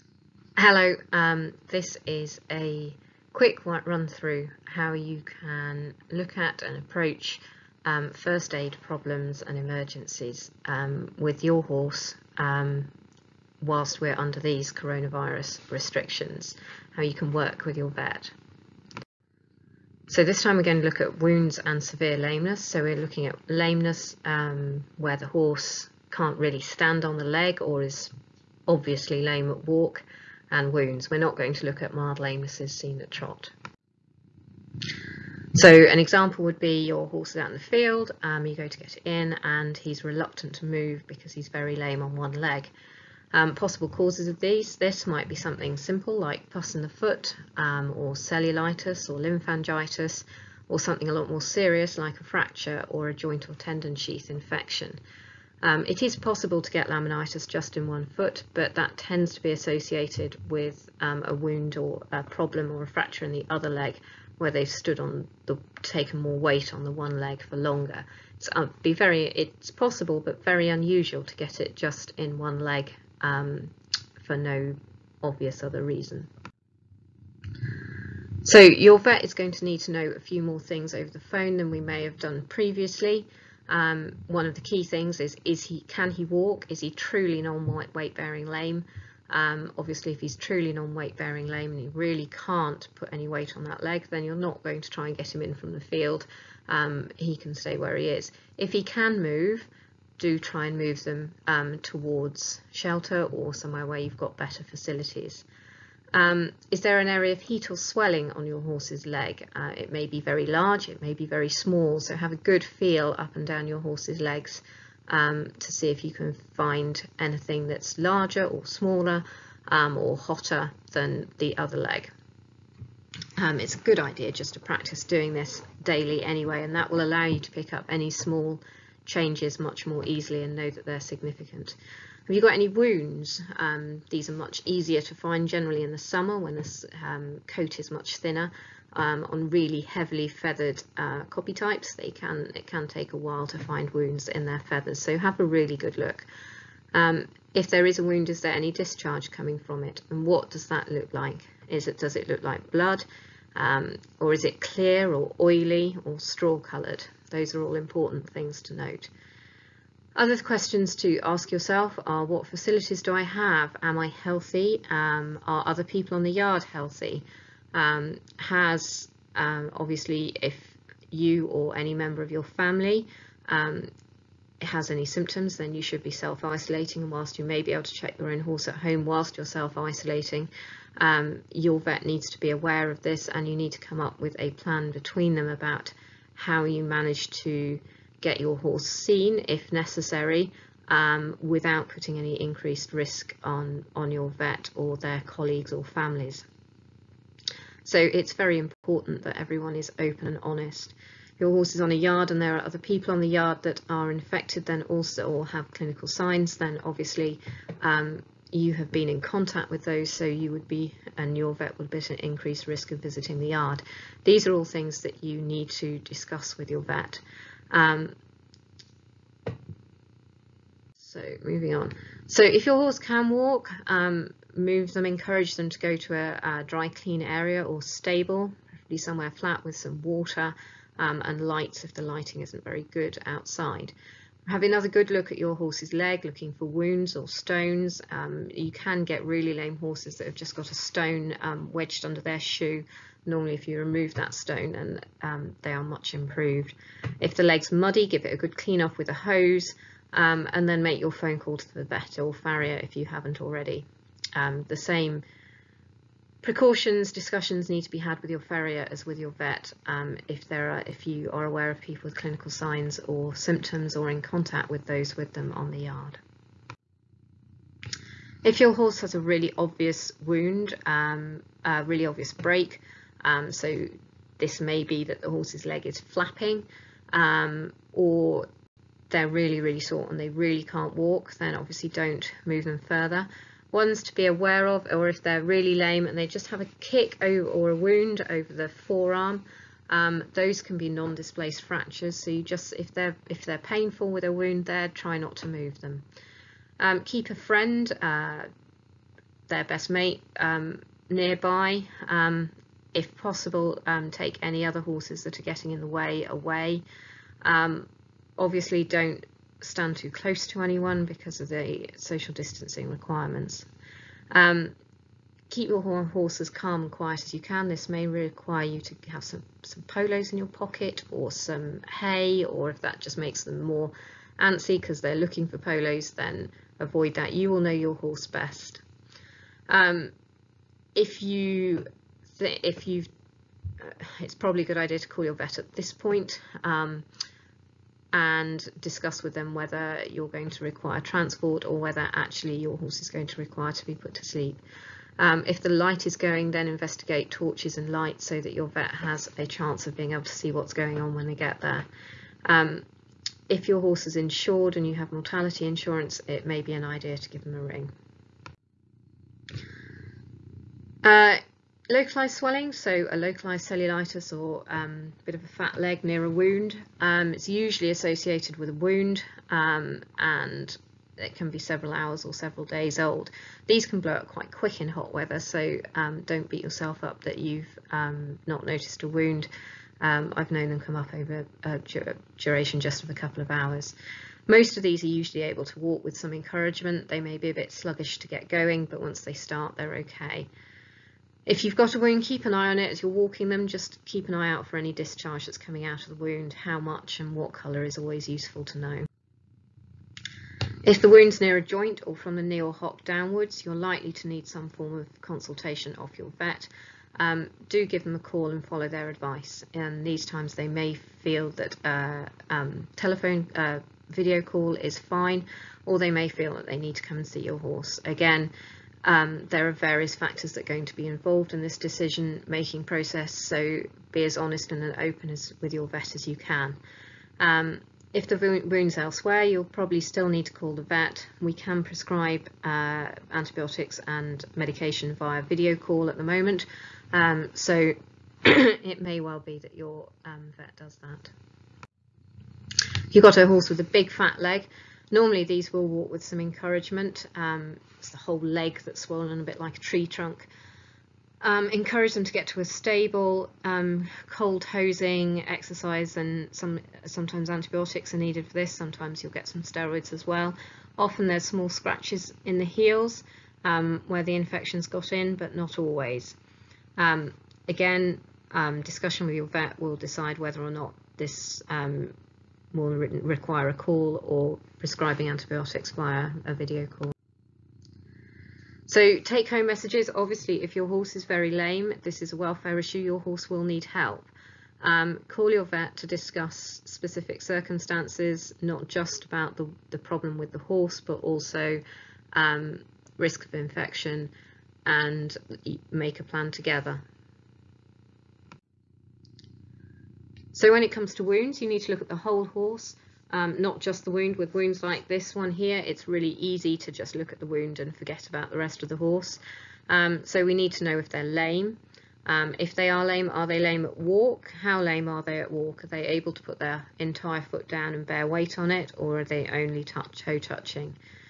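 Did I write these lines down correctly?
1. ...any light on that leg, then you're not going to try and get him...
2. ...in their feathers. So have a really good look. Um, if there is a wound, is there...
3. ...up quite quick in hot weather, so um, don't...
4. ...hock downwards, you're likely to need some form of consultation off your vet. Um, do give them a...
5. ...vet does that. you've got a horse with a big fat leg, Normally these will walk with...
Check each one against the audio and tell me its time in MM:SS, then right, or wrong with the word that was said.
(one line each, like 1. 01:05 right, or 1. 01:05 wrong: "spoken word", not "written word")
1. 01:33 wrong: "weight", not "light"
2. 02:24 right
3. 06:14 right
4. 06:42 right
5. 07:20 right.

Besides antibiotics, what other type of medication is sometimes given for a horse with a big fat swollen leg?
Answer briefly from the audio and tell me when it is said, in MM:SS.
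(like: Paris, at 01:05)
Steroids, at 07:39.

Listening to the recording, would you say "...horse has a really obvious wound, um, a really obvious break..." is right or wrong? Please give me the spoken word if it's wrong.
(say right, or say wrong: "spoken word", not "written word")
right.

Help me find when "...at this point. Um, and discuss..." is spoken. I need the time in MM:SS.
05:35.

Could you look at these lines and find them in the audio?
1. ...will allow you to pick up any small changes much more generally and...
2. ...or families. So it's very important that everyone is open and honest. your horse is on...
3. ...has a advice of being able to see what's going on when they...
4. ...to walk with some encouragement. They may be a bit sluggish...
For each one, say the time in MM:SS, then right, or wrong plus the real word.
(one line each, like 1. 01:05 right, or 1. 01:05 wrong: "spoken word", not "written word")
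1. 02:06 wrong: "easily", not "generally"
2. 03:15 right
3. 05:48 wrong: "chance", not "advice"
4. 06:25 right.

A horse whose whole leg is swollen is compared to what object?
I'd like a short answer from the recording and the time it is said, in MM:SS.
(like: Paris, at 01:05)
A tree trunk, at 07:29.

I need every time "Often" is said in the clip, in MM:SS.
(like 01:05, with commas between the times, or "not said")
07:40.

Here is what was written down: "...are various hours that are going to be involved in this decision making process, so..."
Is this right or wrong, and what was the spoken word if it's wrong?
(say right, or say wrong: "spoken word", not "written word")
wrong: "factors", not "hours".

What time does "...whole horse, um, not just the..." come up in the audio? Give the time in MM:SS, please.
08:22.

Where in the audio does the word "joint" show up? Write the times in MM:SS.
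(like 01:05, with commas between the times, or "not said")
00:53, 06:41.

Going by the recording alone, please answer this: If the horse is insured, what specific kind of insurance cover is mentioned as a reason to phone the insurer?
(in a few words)
Mortality insurance.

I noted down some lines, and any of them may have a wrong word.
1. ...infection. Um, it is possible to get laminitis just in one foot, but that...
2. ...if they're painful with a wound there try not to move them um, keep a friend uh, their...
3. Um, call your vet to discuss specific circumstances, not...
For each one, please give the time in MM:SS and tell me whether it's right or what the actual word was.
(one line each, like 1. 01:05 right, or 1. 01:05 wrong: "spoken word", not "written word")
1. 00:54 right
2. 04:53 right
3. 08:04 right.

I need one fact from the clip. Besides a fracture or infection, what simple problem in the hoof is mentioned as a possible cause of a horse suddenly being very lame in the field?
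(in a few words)
Pus in the foot.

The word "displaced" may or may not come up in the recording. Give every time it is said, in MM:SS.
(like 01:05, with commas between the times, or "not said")
04:50.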